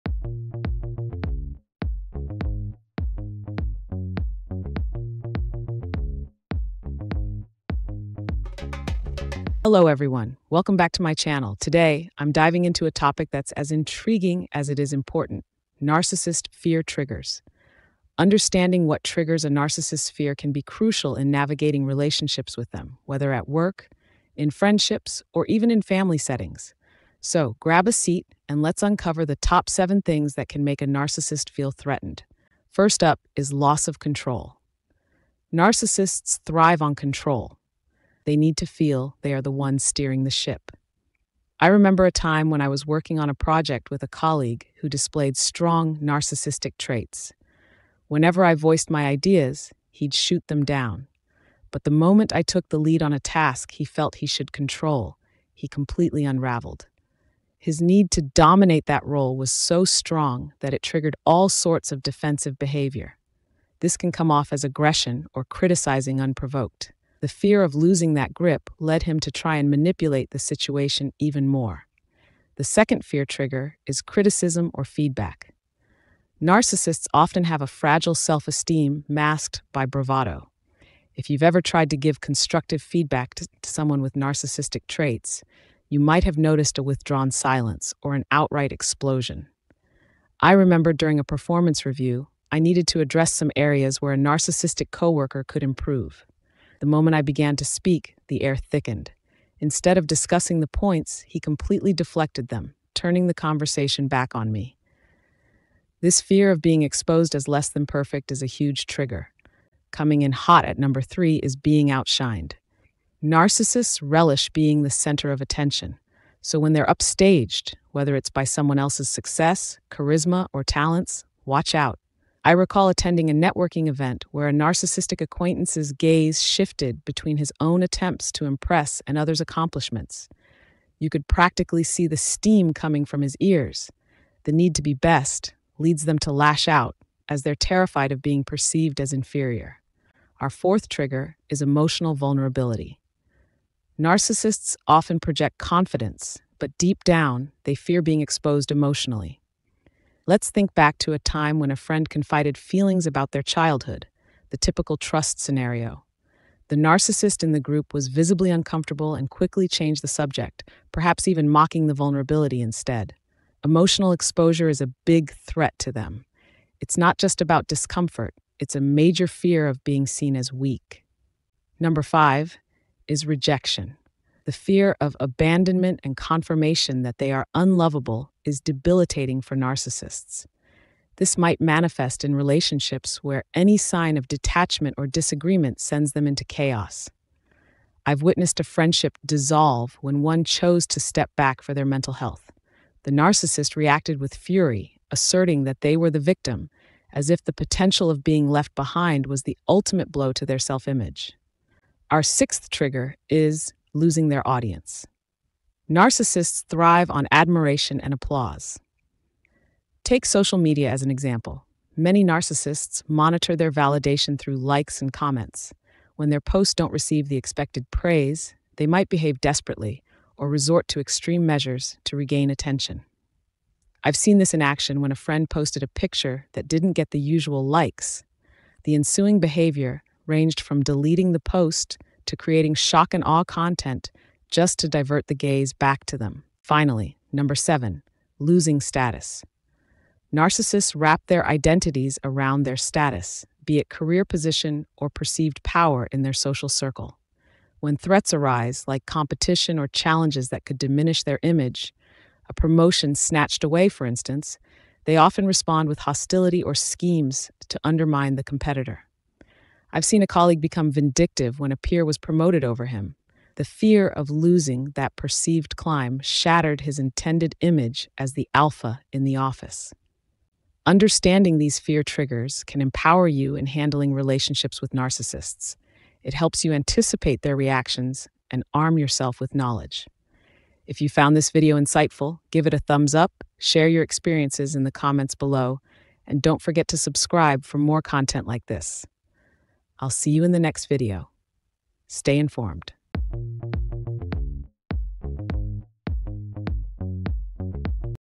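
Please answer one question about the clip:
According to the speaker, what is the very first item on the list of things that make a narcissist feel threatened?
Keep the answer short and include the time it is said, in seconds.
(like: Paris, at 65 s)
Loss of control, at 33 s.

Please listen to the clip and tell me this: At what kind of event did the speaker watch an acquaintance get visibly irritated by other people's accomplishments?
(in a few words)
Networking event.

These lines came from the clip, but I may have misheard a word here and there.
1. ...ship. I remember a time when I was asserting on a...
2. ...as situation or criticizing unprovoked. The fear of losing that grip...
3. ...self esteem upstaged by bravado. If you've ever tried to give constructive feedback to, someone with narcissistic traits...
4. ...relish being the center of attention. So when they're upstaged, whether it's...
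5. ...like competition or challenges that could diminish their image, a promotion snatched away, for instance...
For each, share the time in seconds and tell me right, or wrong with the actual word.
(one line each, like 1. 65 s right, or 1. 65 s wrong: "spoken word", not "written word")
1. 40 s wrong: "working", not "asserting"
2. 64 s wrong: "aggression", not "situation"
3. 78 s wrong: "masked", not "upstaged"
4. 114 s right
5. 248 s right.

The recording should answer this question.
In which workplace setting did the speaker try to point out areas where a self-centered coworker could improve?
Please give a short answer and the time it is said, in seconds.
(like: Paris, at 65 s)
Performance review, at 91 s.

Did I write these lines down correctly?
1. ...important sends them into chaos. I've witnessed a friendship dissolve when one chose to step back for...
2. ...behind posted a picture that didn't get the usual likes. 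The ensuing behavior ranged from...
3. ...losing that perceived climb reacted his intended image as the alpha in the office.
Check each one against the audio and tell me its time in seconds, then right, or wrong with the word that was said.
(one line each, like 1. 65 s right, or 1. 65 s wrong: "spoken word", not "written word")
1. 185 s wrong: "disagreement", not "important"
2. 225 s wrong: "friend", not "behind"
3. 264 s wrong: "shattered", not "reacted".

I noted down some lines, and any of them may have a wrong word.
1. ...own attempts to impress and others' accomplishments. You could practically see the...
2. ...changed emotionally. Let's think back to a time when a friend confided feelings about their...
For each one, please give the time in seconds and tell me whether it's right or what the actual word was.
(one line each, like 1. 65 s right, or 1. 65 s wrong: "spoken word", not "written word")
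1. 127 s right
2. 148 s wrong: "exposed", not "changed".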